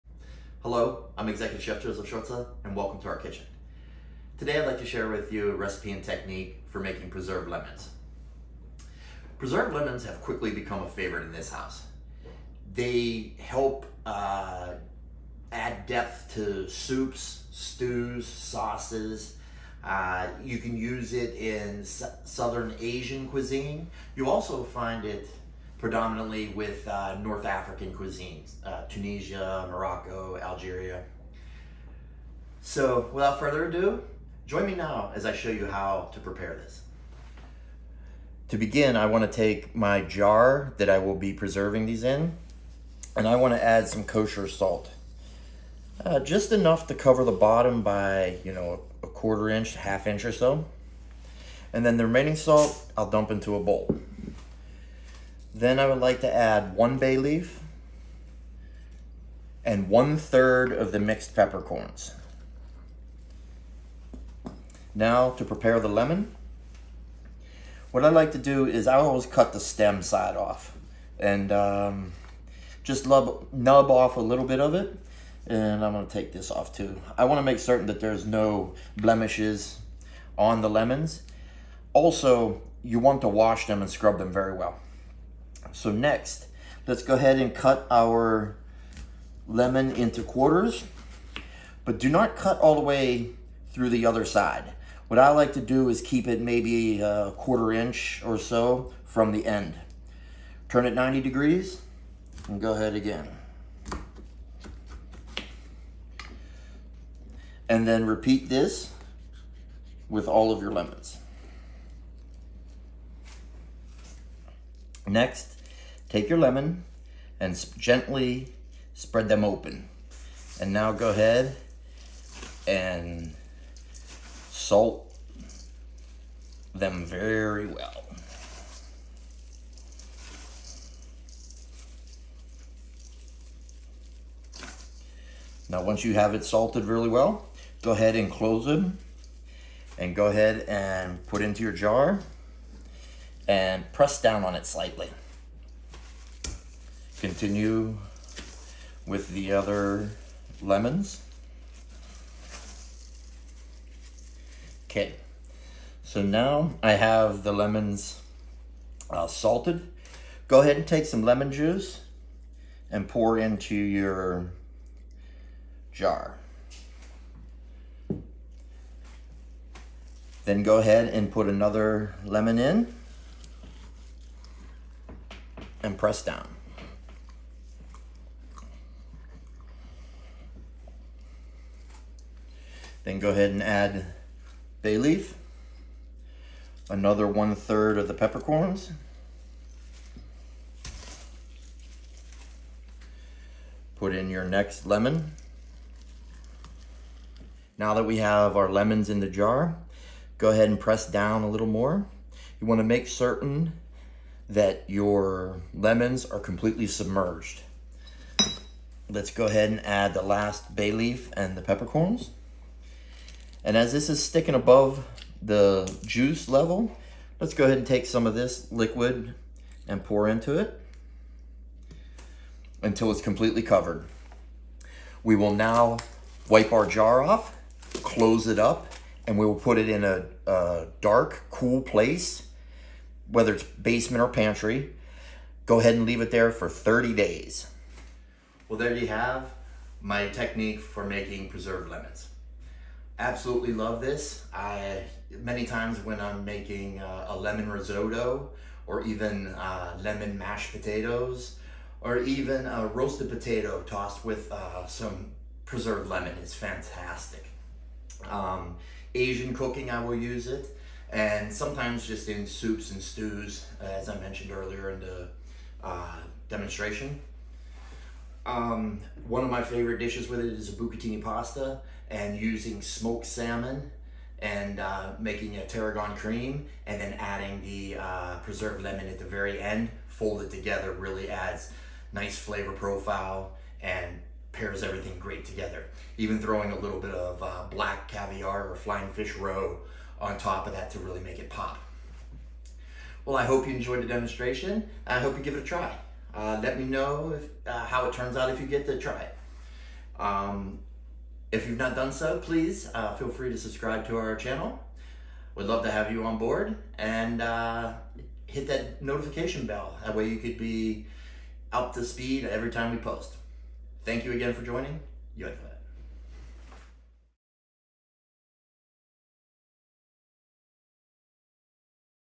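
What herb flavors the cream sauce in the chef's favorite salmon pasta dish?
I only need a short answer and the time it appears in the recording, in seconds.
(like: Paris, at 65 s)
tarragon, at 275 s.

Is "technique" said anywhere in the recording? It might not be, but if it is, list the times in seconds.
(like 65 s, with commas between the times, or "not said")
6 s, 240 s.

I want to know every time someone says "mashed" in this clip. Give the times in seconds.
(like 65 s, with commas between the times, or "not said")
250 s.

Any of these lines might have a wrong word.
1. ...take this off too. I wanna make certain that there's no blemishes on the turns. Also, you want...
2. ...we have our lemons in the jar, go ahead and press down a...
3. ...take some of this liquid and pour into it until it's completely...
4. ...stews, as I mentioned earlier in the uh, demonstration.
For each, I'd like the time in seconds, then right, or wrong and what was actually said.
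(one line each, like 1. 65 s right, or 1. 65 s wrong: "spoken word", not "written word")
1. 76 s wrong: "lemons", not "turns"
2. 198 s right
3. 217 s right
4. 263 s right.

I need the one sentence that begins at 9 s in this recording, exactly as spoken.
Preserved lemons have quickly become a favorite in this house.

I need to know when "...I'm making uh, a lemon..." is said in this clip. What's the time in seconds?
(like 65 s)
246 s.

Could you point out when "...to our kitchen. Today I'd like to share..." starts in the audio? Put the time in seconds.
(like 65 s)
3 s.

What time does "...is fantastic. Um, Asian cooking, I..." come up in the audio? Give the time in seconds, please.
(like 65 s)
256 s.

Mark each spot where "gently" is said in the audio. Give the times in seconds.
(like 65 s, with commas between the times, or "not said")
117 s.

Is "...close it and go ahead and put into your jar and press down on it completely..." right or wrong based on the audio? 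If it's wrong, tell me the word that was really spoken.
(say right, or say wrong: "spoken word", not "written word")
wrong: "slightly", not "completely".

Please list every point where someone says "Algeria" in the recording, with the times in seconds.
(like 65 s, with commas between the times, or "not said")
30 s.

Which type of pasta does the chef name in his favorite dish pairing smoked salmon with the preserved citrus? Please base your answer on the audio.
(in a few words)
bucatini.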